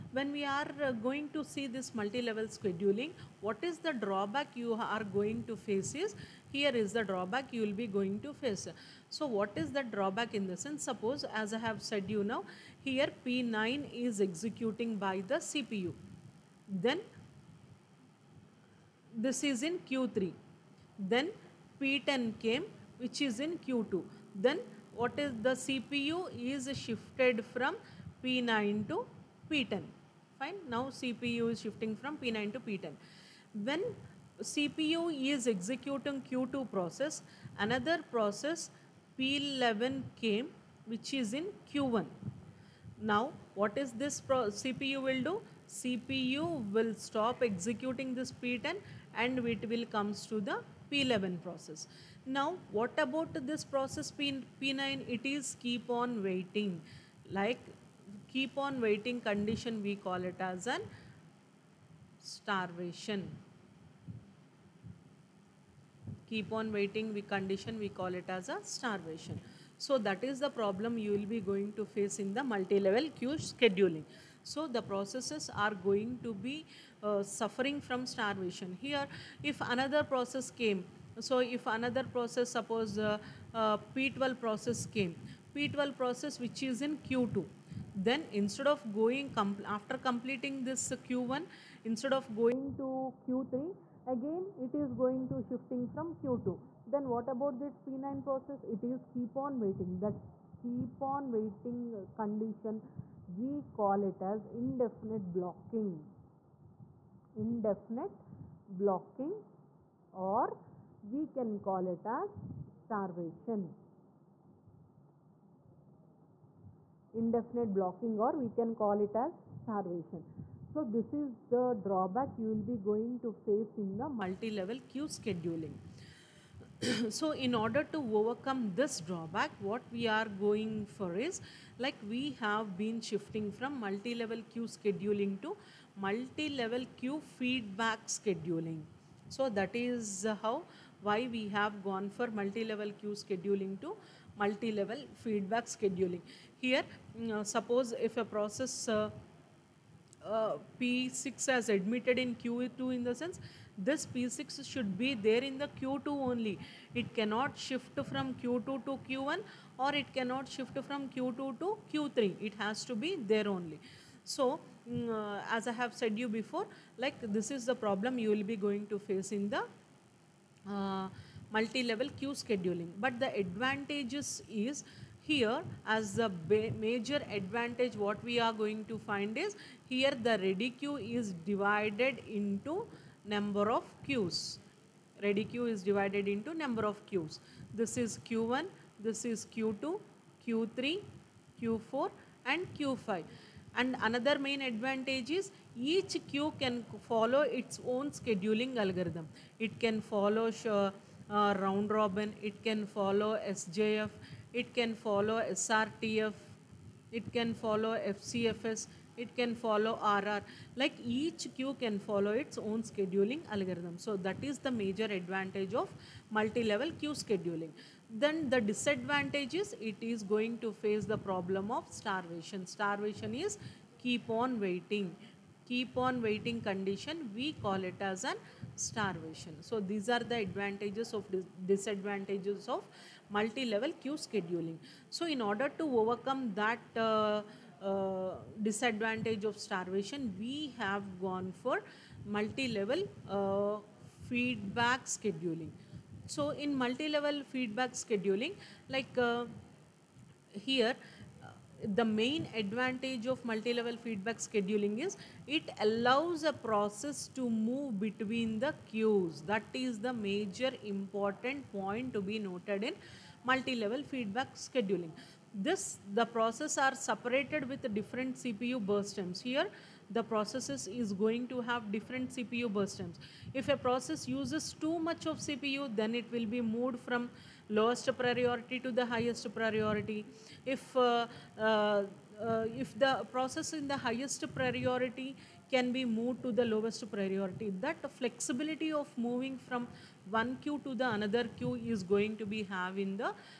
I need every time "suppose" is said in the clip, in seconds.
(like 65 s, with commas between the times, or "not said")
10 s, 82 s, 147 s.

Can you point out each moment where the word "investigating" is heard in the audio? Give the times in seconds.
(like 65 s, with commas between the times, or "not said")
not said.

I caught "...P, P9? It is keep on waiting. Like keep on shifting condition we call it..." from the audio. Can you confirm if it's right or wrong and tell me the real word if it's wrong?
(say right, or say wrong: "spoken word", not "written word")
wrong: "waiting", not "shifting".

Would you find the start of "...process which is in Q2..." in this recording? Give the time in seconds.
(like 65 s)
85 s.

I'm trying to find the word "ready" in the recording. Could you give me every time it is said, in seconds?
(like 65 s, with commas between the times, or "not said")
180 s, 185 s.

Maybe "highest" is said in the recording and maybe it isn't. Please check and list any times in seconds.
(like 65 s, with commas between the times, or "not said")
279 s, 283 s.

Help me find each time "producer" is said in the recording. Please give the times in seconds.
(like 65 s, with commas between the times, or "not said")
not said.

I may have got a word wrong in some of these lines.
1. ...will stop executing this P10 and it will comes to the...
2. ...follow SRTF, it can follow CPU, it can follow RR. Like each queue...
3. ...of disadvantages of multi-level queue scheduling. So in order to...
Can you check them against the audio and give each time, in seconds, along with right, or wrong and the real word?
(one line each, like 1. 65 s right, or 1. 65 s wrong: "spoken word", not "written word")
1. 46 s right
2. 205 s wrong: "FCFS", not "CPU"
3. 231 s right.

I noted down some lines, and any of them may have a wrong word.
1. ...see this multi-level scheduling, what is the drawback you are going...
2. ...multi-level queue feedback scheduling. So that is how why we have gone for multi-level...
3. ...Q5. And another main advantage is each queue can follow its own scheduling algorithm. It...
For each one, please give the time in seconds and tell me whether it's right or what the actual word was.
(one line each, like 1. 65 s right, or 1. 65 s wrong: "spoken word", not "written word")
1. 1 s right
2. 135 s right
3. 192 s right.